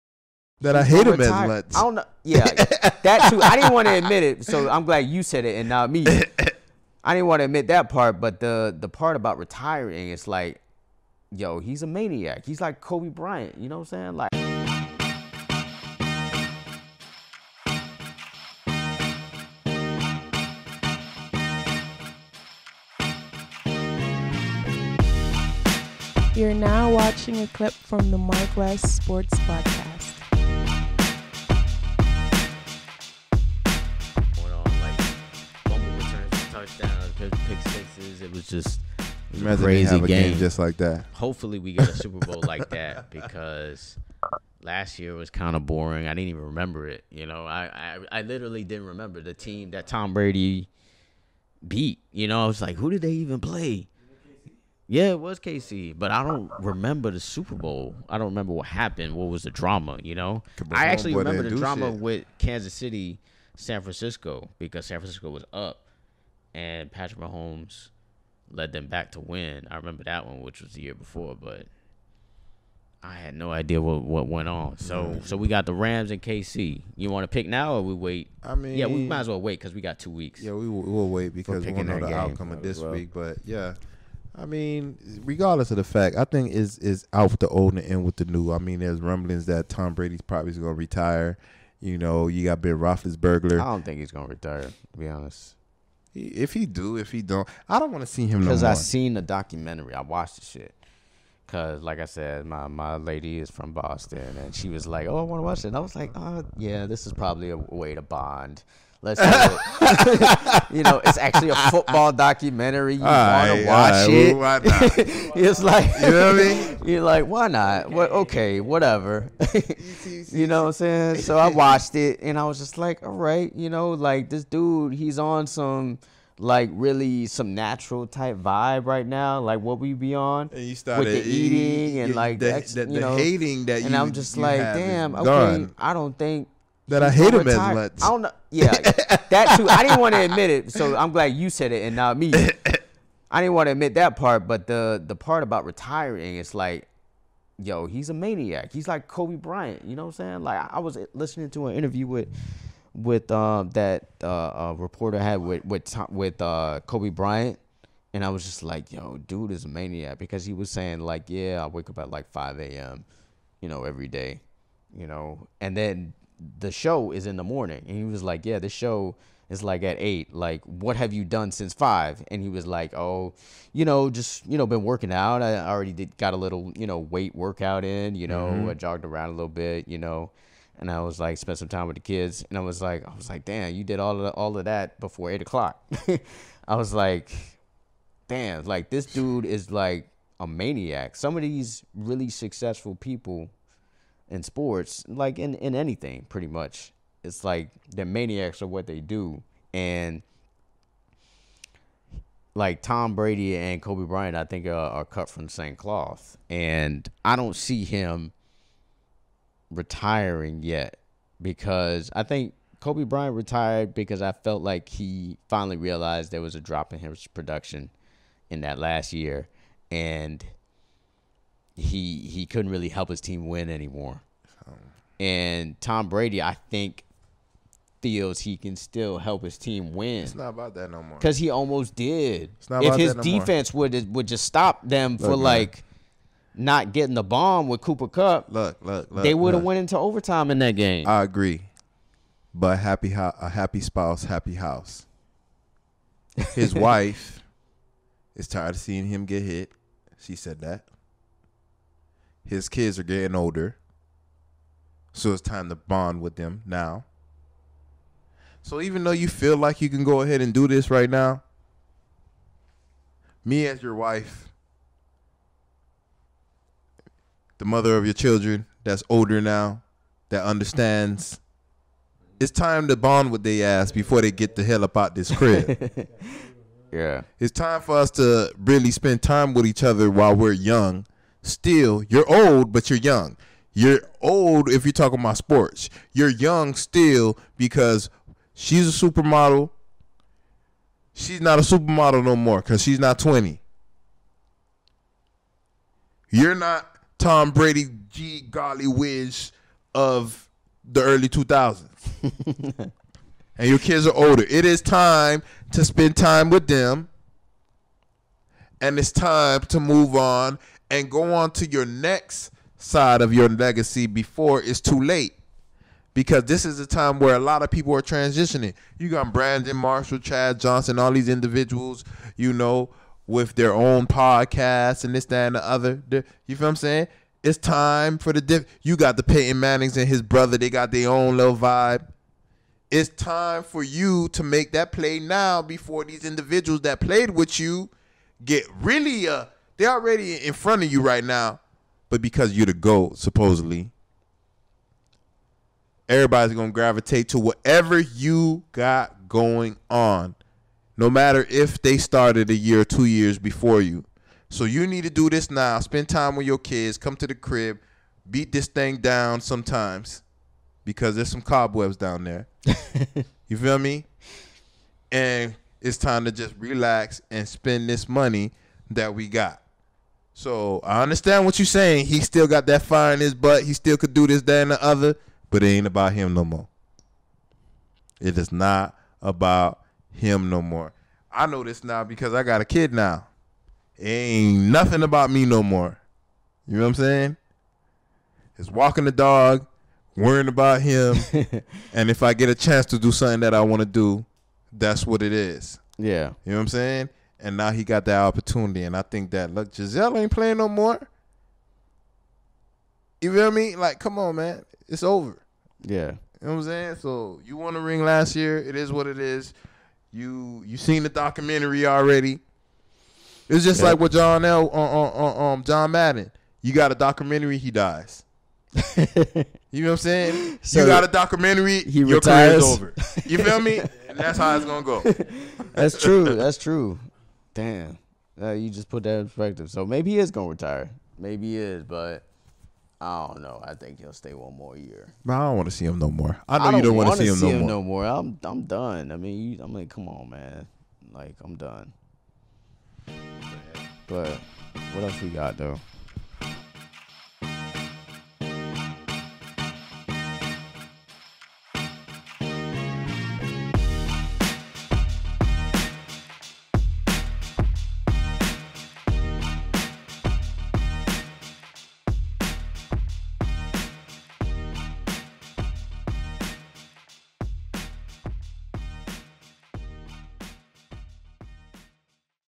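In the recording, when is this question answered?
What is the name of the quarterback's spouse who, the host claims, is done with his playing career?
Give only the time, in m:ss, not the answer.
6:39.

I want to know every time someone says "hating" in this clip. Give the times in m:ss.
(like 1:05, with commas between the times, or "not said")
2:13.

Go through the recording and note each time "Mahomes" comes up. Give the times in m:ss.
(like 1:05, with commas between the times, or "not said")
1:07.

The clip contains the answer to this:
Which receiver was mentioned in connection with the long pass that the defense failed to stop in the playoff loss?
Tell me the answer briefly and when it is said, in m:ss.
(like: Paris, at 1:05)
Cooper Kupp, at 3:57.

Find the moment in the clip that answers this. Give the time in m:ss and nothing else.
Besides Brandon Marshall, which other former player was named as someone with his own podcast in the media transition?
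5:20.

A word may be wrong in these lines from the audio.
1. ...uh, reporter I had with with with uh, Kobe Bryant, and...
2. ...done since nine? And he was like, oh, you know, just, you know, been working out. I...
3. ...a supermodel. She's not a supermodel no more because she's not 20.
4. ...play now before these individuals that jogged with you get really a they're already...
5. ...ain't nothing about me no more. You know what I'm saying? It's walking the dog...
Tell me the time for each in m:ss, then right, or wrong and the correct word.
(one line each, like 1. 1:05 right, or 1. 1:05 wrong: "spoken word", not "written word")
1. 2:34 right
2. 2:51 wrong: "five", not "nine"
3. 4:48 right
4. 5:34 wrong: "played", not "jogged"
5. 6:24 right.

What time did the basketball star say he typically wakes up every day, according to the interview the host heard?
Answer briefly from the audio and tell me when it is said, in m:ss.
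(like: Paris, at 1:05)
5 a.m., at 2:42.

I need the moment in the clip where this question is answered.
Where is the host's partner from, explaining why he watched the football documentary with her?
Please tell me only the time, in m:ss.
1:43.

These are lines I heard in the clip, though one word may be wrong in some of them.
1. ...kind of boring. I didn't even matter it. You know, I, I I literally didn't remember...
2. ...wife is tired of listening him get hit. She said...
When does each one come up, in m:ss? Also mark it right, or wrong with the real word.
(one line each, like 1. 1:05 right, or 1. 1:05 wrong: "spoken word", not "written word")
1. 0:45 wrong: "remember", not "matter"
2. 4:06 wrong: "seeing", not "listening".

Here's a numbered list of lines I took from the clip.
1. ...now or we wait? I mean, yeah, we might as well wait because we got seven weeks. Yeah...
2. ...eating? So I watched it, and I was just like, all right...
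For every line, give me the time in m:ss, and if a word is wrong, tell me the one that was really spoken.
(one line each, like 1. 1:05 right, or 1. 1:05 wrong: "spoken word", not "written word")
1. 1:17 wrong: "two", not "seven"
2. 2:00 wrong: "saying", not "eating".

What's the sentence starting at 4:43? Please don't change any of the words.
You're old if you're talking about sports.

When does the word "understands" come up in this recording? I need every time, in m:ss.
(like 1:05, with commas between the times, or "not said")
4:30, 6:11.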